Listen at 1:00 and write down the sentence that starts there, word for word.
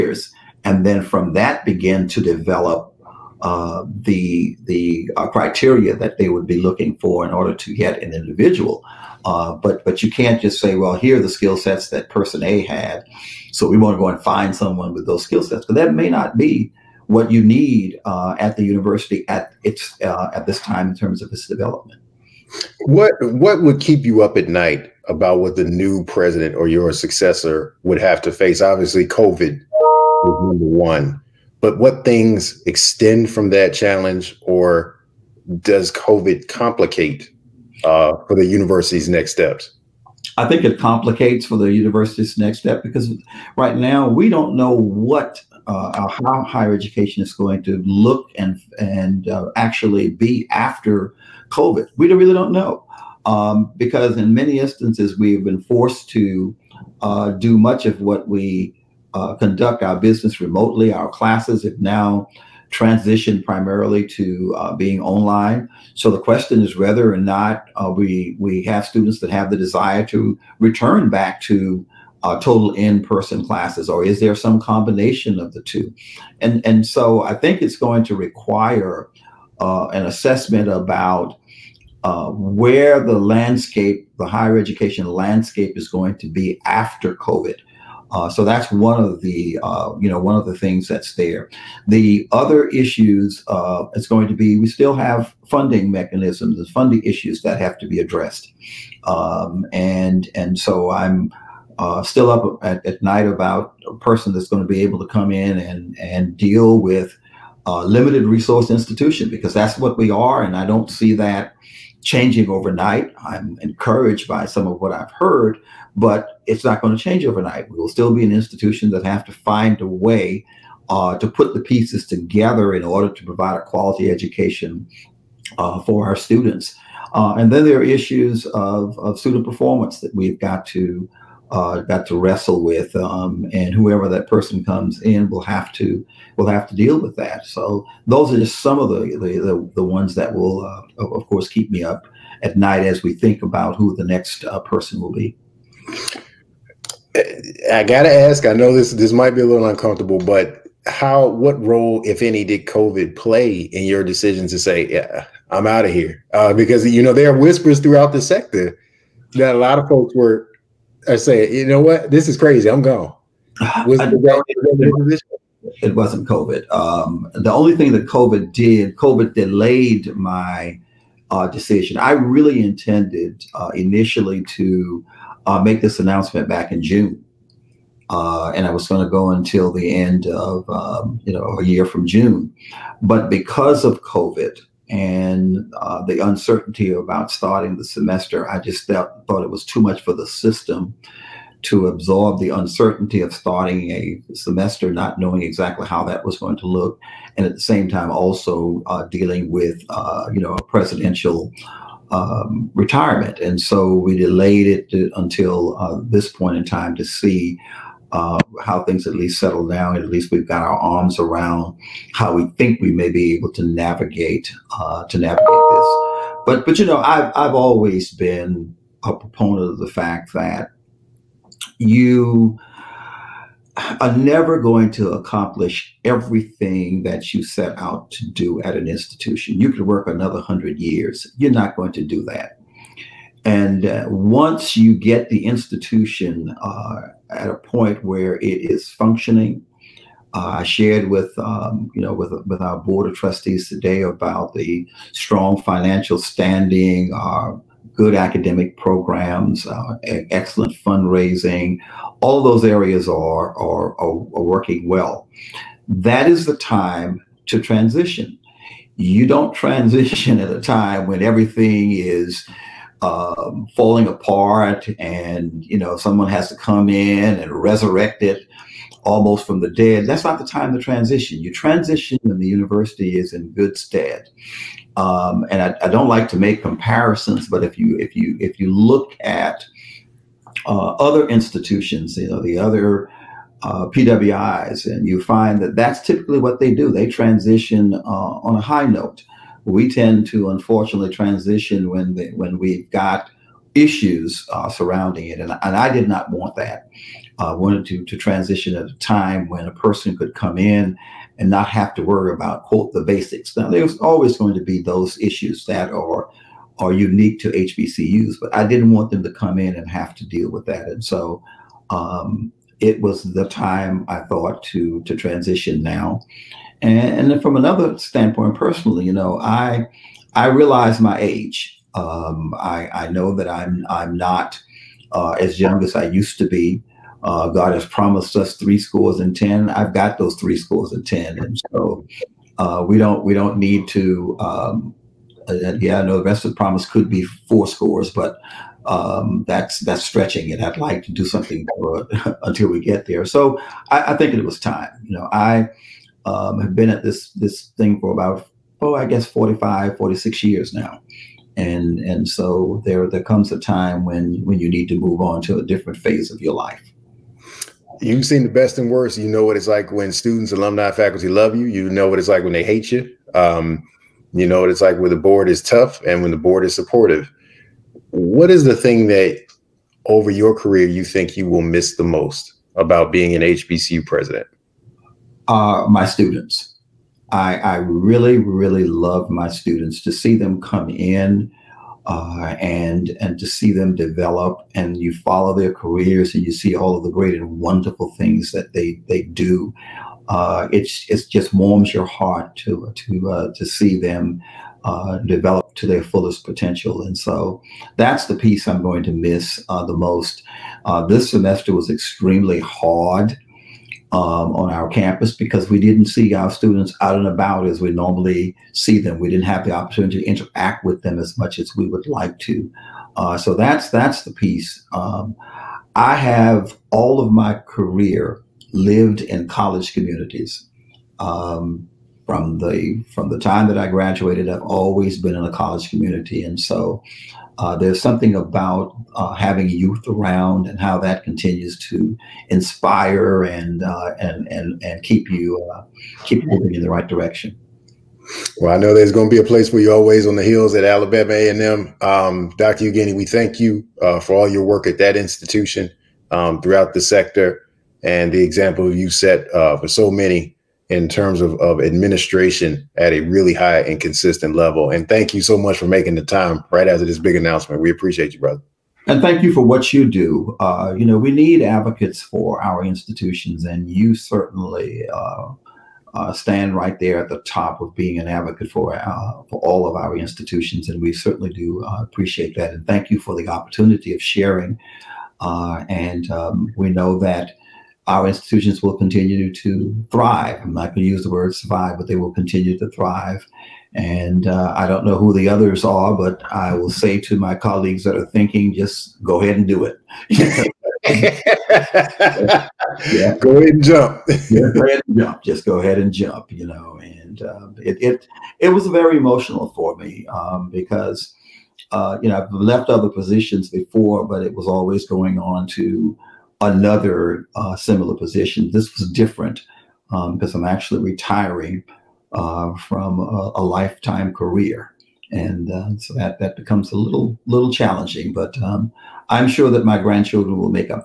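Our classes have now transitioned primarily to uh, being online.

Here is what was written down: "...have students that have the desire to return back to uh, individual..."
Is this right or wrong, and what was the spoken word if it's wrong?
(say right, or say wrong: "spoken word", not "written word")
wrong: "total", not "individual".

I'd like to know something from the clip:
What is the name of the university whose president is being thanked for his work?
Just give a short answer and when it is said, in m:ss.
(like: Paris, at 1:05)
Alabama A&M, at 7:20.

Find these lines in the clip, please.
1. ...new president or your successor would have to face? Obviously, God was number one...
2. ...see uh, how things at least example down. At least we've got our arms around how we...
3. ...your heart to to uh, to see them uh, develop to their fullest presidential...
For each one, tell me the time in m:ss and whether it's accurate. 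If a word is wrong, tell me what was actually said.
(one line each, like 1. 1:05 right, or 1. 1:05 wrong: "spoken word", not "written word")
1. 0:25 wrong: "COVID", not "God"
2. 3:27 wrong: "settle", not "example"
3. 6:31 wrong: "potential", not "presidential".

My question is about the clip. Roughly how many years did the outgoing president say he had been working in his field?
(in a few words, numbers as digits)
45, 46 years.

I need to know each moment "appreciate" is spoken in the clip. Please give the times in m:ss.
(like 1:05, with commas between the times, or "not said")
7:37, 7:52.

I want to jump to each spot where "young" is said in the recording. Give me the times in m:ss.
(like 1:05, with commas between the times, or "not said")
5:25.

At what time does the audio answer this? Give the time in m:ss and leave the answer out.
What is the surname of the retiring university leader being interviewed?
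7:22.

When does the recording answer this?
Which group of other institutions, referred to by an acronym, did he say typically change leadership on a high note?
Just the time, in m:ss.
4:43.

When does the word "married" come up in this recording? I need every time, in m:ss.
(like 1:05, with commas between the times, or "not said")
not said.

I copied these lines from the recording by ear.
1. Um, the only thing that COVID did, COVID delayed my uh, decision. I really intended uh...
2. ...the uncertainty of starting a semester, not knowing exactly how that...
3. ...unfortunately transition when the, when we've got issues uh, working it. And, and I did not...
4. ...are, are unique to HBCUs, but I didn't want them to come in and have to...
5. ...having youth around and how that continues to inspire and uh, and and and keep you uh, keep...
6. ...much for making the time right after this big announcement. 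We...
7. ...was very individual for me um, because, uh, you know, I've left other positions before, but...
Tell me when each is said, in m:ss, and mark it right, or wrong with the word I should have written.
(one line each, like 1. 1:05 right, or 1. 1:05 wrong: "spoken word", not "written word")
1. 2:46 right
2. 3:12 right
3. 4:50 wrong: "surrounding", not "working"
4. 5:05 right
5. 7:09 right
6. 7:35 right
7. 8:18 wrong: "emotional", not "individual".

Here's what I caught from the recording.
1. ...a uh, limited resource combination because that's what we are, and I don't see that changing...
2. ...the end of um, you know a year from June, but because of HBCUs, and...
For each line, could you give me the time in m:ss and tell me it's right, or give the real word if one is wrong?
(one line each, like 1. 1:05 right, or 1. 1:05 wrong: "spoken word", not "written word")
1. 1:47 wrong: "institution", not "combination"
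2. 2:59 wrong: "COVID", not "HBCUs".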